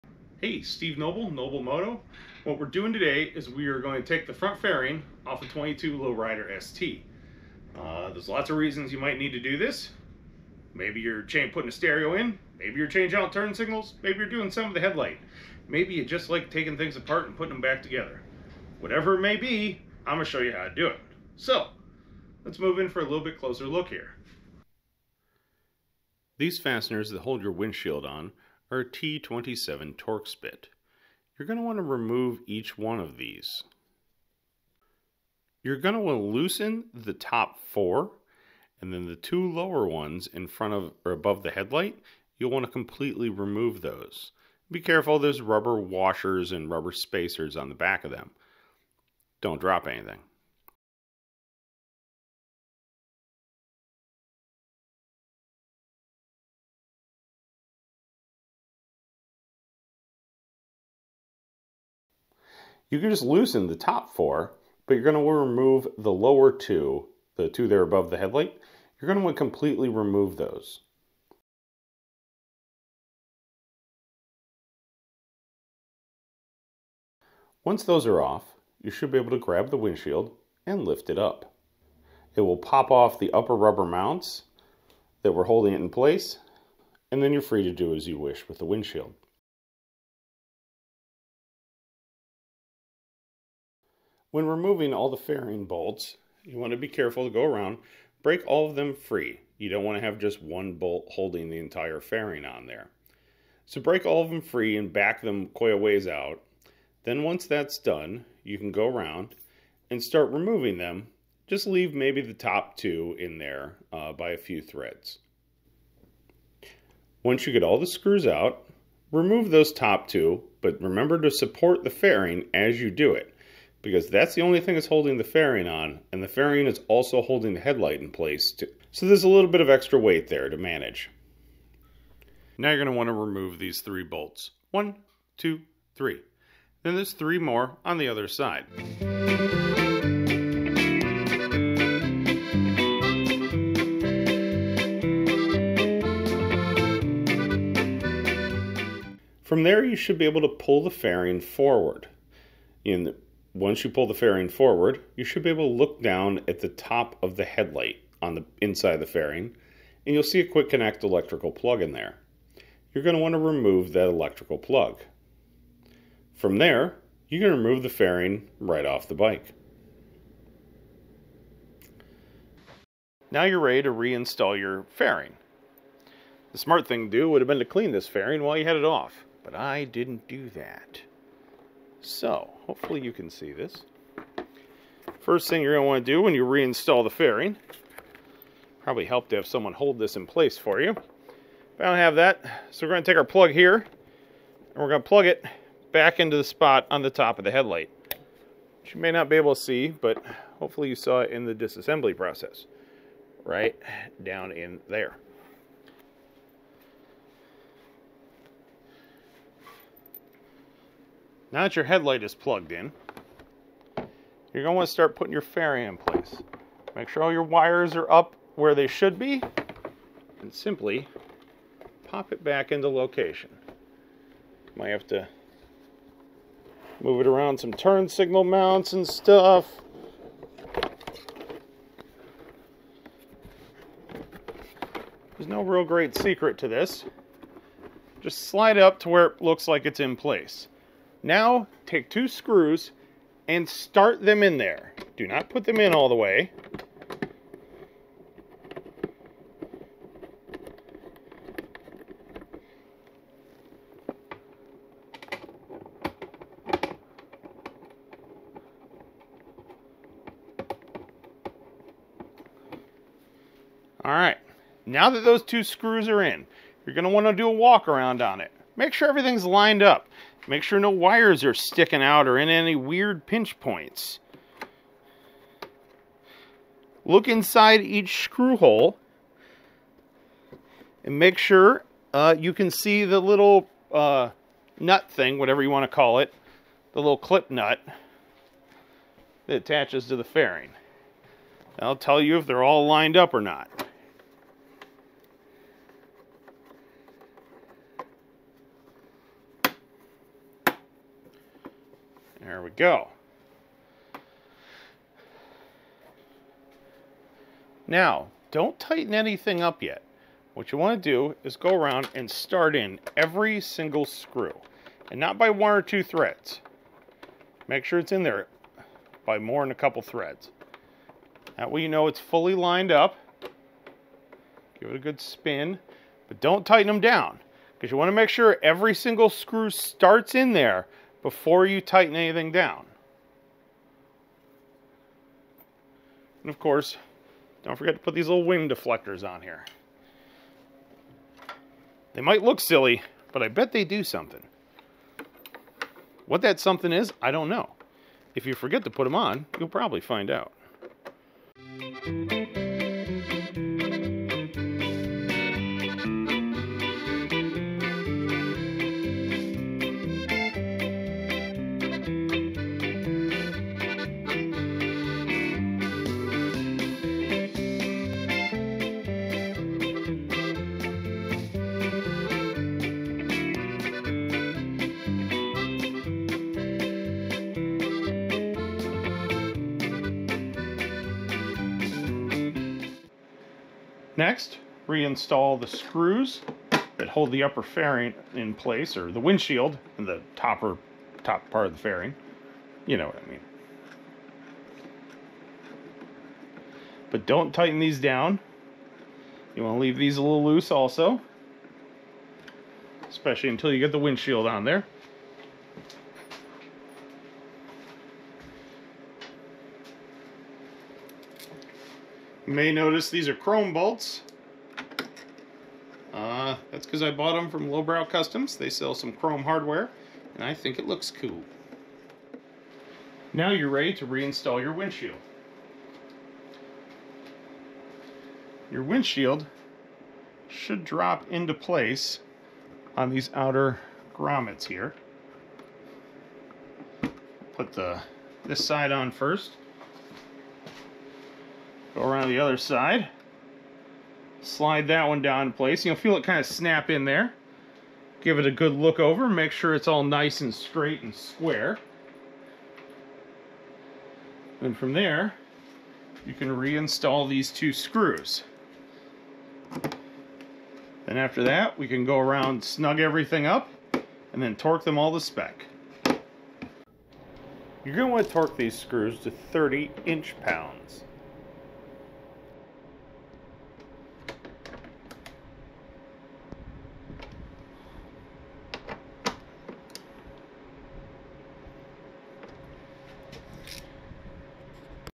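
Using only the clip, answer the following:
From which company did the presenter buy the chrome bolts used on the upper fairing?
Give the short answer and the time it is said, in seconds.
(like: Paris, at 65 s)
Lowbrow Customs, at 417 s.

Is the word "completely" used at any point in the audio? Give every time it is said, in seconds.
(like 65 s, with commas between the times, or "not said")
42 s, 69 s.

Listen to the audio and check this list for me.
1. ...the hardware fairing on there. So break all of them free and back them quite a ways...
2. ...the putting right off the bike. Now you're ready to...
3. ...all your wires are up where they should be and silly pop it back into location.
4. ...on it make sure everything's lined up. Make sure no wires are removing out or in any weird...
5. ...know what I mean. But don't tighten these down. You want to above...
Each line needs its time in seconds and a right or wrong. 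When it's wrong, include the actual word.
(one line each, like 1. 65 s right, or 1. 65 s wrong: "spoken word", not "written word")
1. 101 s wrong: "entire", not "hardware"
2. 167 s wrong: "fairing", not "putting"
3. 217 s wrong: "simply", not "silly"
4. 268 s wrong: "sticking", not "removing"
5. 392 s wrong: "leave", not "above".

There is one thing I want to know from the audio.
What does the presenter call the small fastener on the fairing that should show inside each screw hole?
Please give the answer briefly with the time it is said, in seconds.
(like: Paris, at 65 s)
clip nut, at 287 s.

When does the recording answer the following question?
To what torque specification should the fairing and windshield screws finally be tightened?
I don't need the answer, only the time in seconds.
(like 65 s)
469 s.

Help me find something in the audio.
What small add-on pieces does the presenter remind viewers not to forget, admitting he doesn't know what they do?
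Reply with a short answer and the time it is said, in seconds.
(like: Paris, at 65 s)
wing deflectors, at 338 s.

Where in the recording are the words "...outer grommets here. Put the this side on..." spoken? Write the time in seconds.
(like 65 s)
433 s.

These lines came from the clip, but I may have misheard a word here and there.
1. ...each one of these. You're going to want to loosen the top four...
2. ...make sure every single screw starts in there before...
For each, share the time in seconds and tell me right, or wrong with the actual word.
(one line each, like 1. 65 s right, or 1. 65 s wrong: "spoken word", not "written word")
1. 32 s right
2. 328 s right.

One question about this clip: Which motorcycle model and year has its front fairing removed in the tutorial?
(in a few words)
2022 Lowrider ST.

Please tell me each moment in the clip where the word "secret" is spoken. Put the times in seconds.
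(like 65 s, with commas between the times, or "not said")
236 s.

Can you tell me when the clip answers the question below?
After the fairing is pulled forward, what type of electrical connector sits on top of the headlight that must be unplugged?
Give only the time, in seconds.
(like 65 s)
160 s.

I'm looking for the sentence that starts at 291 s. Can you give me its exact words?
I'll tell you if they're all lined up or not.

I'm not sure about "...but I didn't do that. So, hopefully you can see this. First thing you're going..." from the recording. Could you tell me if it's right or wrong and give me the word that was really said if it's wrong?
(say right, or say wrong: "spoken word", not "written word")
right.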